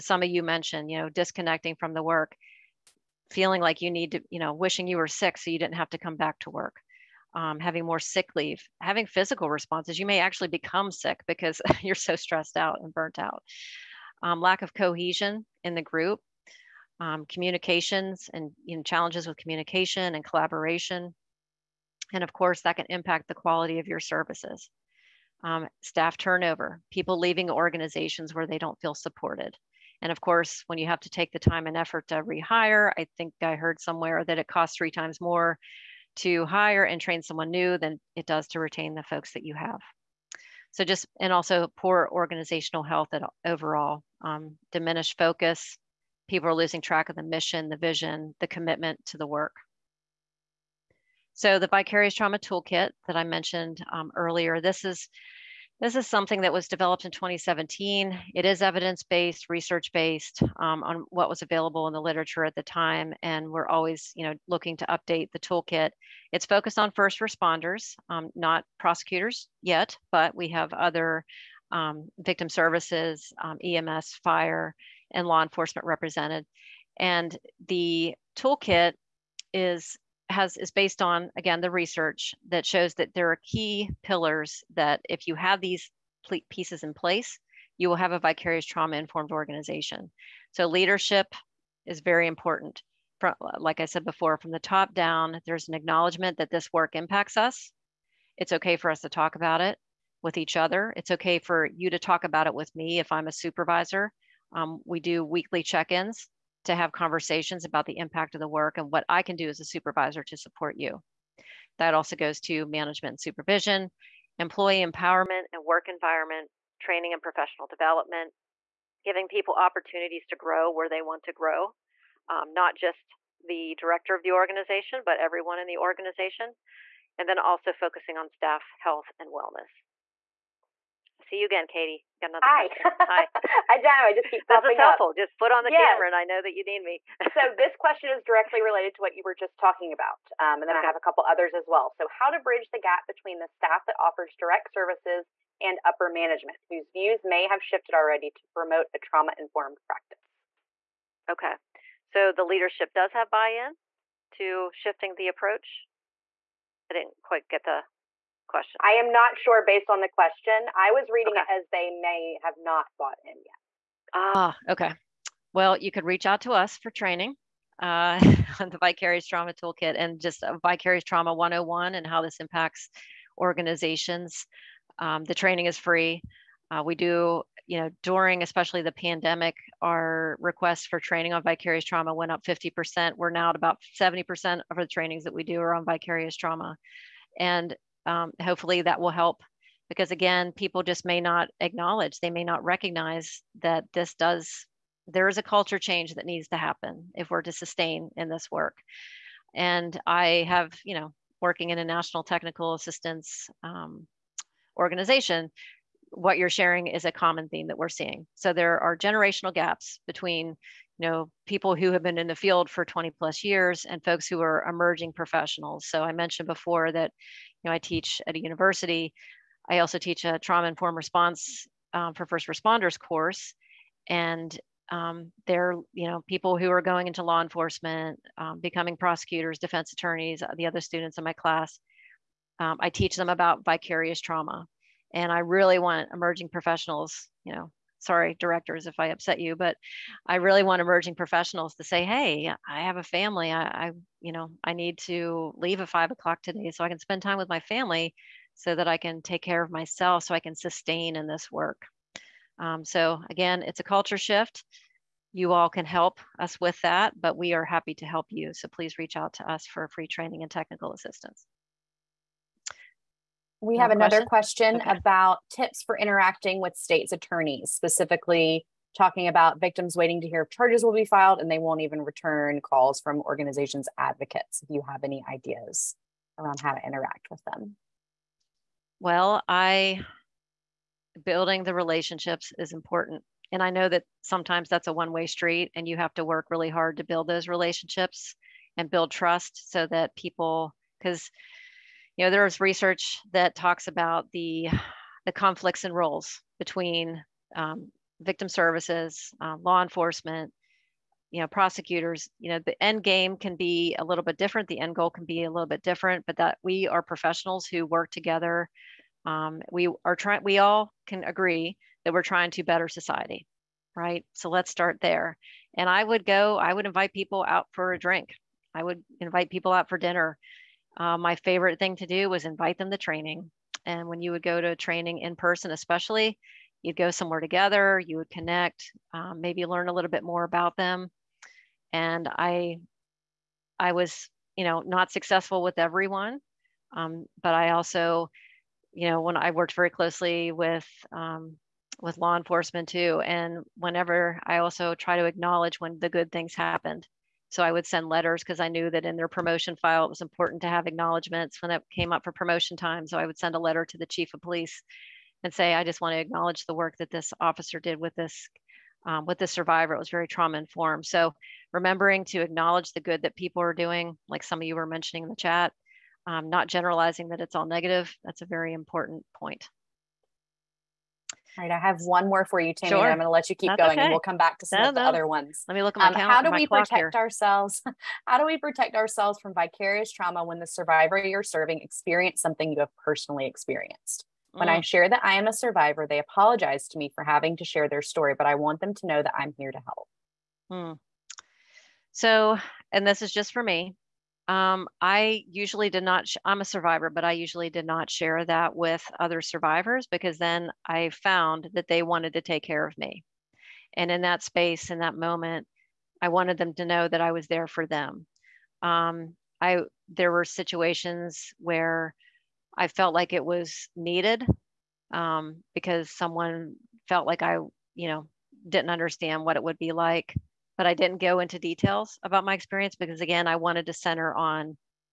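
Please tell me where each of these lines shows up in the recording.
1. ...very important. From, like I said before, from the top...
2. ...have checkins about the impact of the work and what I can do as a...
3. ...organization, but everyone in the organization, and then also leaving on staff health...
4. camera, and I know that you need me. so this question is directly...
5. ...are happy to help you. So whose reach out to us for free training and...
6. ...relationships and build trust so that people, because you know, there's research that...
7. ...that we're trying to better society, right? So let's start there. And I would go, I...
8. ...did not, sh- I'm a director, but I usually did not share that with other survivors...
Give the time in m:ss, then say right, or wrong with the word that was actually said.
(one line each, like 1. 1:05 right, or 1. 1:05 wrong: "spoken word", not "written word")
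1. 1:31 right
2. 1:46 wrong: "conversations", not "checkins"
3. 2:04 wrong: "focusing", not "leaving"
4. 2:15 right
5. 4:17 wrong: "please", not "whose"
6. 4:47 right
7. 5:12 right
8. 6:35 wrong: "survivor", not "director".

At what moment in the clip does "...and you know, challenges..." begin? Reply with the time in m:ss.
0:18.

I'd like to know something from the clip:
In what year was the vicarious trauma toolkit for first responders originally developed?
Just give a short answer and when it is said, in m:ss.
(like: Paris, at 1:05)
2017, at 0:57.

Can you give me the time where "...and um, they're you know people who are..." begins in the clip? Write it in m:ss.
3:44.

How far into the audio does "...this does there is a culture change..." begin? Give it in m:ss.
3:13.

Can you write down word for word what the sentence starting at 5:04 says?
The end goal can be a little bit different, but that we are professionals who work together.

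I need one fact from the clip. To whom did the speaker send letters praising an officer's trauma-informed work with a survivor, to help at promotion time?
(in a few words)
the chief of police.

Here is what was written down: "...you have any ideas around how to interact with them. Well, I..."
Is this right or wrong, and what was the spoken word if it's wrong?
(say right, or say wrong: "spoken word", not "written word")
right.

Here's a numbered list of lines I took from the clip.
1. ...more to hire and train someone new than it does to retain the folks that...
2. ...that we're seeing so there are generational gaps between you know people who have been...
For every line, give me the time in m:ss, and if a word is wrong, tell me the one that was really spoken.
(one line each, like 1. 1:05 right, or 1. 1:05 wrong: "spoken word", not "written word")
1. 0:35 right
2. 3:27 right.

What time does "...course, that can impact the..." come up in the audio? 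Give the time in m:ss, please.
0:22.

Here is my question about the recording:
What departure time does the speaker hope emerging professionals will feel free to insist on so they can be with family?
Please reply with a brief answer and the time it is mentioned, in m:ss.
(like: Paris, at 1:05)
5 o'clock, at 4:05.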